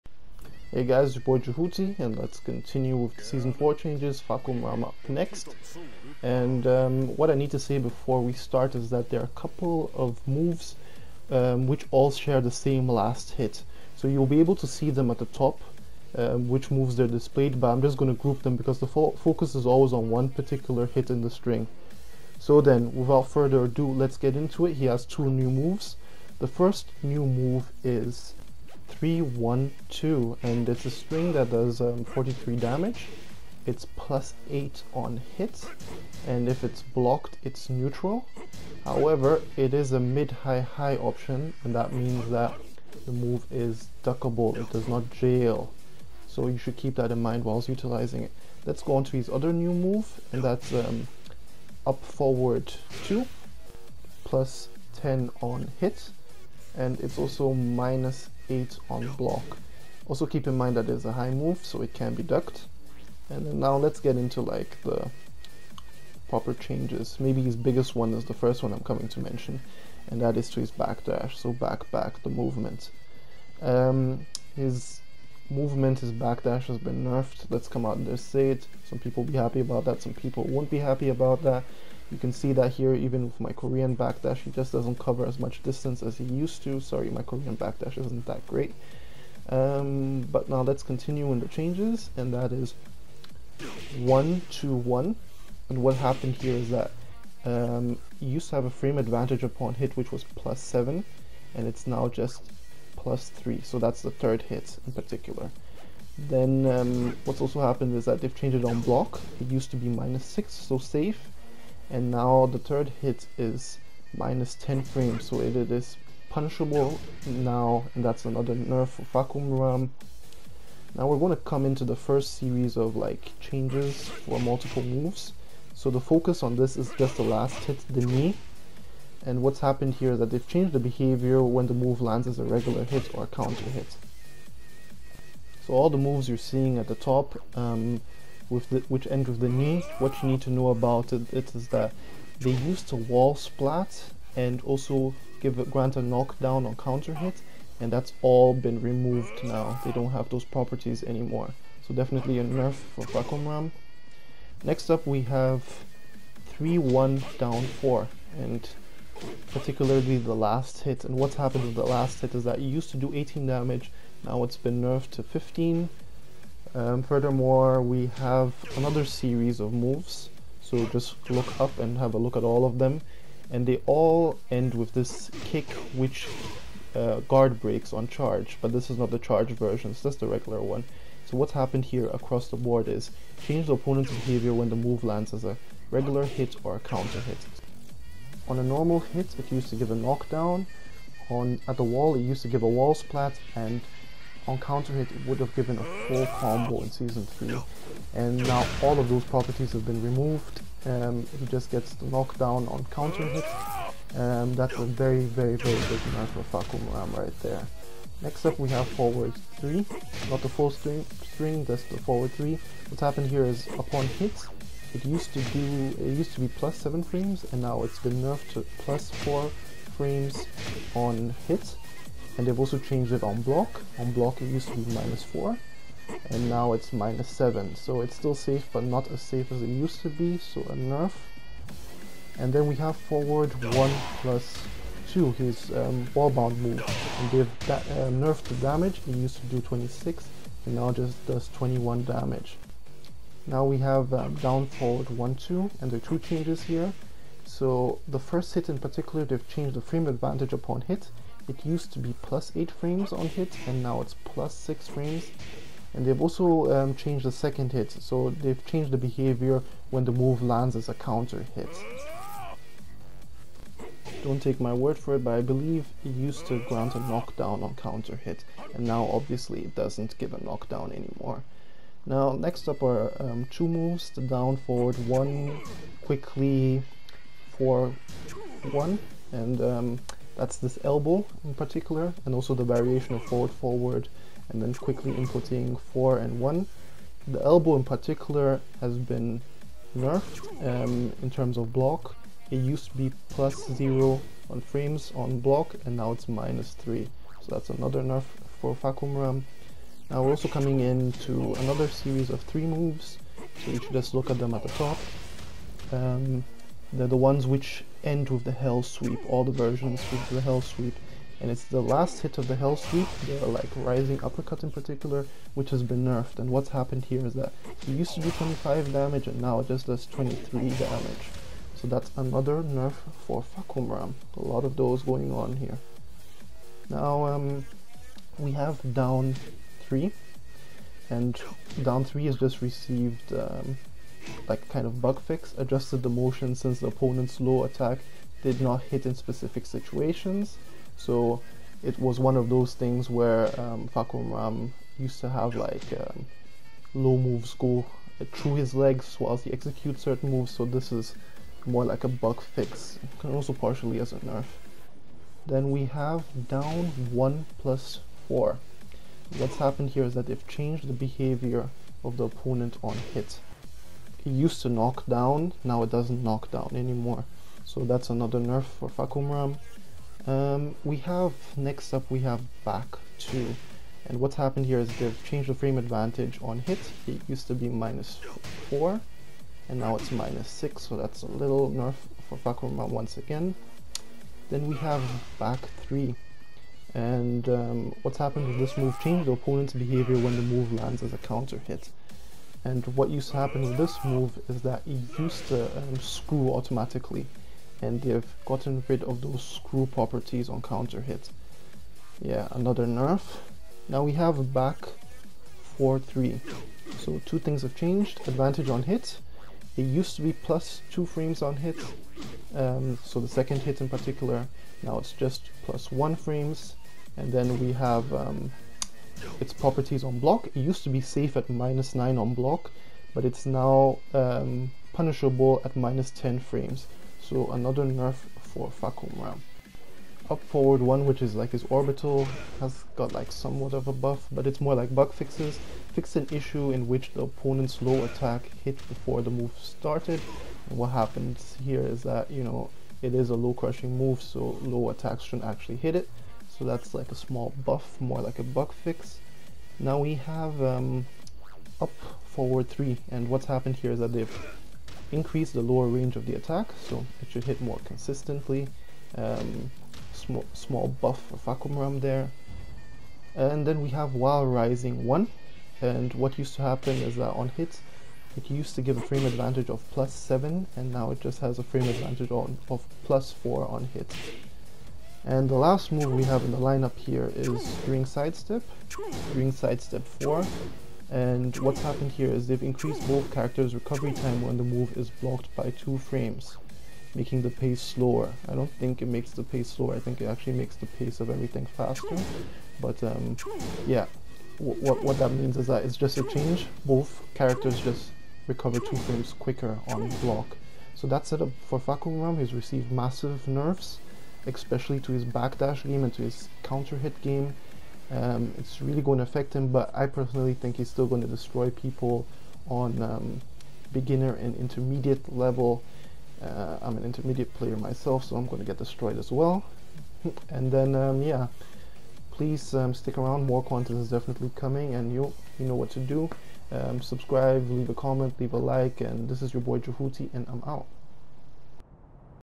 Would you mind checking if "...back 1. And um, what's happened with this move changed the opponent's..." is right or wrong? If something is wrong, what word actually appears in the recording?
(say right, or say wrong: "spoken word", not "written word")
wrong: "3", not "1".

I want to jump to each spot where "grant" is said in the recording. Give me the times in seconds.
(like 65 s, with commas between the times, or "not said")
145 s, 266 s.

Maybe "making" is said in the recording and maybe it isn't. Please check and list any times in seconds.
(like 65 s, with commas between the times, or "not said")
487 s.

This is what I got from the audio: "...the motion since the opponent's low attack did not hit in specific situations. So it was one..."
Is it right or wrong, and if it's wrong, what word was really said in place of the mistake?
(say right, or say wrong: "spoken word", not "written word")
right.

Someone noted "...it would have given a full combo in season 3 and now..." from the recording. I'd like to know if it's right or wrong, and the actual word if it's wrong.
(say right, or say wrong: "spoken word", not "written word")
right.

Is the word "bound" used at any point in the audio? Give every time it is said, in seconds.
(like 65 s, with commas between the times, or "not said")
236 s.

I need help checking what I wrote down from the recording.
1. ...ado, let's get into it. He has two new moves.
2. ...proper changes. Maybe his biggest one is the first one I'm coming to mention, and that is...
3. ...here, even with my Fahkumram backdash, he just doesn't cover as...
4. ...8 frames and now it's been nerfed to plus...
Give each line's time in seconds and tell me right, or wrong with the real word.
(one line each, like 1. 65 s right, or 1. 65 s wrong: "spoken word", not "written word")
1. 23 s right
2. 66 s right
3. 82 s wrong: "Korean", not "Fahkumram"
4. 216 s wrong: "7", not "8".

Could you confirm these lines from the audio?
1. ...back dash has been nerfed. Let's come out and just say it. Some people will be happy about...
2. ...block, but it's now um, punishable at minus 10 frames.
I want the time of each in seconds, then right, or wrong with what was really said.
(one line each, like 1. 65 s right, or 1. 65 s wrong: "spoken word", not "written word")
1. 76 s right
2. 422 s right.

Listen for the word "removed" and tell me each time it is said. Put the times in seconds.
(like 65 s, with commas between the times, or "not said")
148 s, 200 s.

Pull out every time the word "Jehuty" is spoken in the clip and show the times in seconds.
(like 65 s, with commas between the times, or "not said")
1 s, 529 s.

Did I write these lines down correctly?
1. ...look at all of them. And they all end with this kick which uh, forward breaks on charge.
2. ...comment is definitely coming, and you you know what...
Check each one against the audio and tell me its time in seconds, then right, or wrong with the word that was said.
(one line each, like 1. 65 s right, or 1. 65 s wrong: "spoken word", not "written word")
1. 172 s wrong: "guard", not "forward"
2. 523 s wrong: "content", not "comment".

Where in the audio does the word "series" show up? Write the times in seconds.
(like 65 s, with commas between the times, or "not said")
122 s, 169 s, 301 s.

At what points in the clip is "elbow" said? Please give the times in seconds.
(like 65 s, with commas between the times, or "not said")
280 s, 287 s.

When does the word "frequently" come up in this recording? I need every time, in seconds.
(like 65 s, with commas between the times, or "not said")
not said.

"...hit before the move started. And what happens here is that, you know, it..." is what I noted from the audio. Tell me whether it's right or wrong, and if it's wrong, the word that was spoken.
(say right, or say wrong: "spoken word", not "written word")
right.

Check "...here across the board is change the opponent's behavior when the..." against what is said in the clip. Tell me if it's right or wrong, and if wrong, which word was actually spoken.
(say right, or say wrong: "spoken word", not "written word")
right.